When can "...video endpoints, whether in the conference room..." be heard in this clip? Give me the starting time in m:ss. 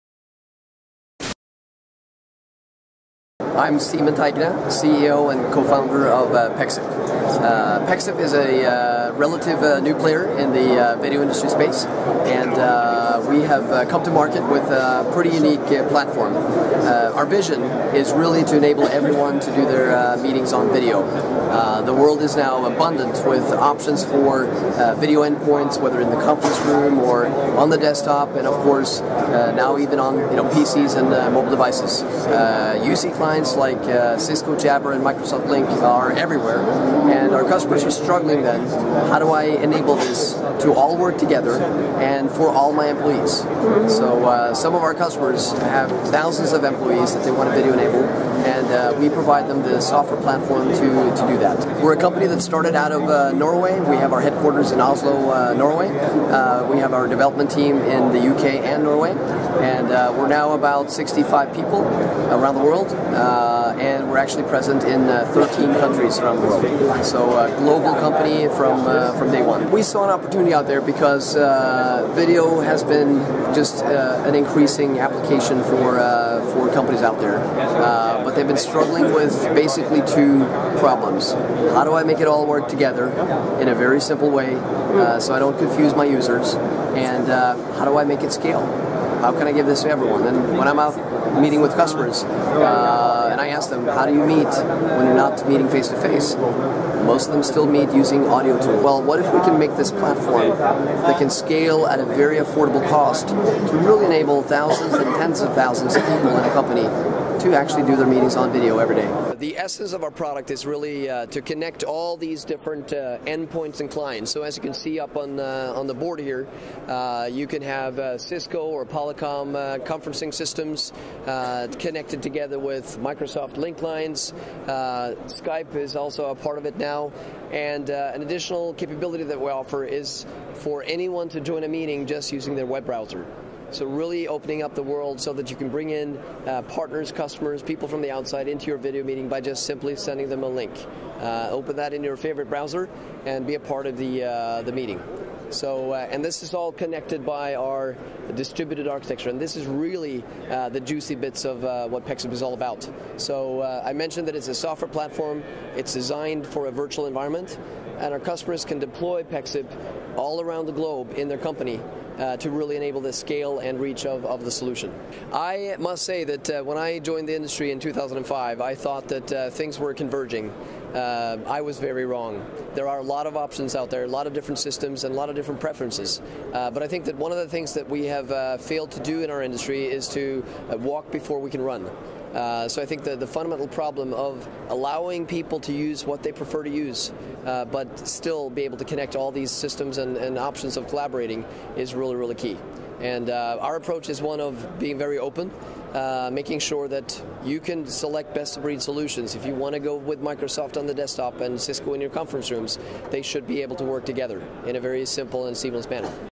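0:24.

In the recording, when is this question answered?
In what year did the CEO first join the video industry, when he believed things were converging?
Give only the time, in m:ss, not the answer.
2:47.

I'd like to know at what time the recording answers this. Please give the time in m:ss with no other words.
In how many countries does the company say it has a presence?
1:05.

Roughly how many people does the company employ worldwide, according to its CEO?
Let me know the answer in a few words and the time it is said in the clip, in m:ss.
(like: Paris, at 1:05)
65, at 1:00.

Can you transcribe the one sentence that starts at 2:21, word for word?
Uh, open that in your favorite browser and be a part of the, uh, the meeting.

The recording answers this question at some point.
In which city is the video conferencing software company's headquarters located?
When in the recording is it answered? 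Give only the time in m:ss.
0:54.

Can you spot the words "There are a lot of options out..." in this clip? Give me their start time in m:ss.
2:52.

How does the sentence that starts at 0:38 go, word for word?
Then, how do I enable this to all work together and for all my employees?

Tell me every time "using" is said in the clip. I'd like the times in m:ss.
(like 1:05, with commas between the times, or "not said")
1:37, 2:12.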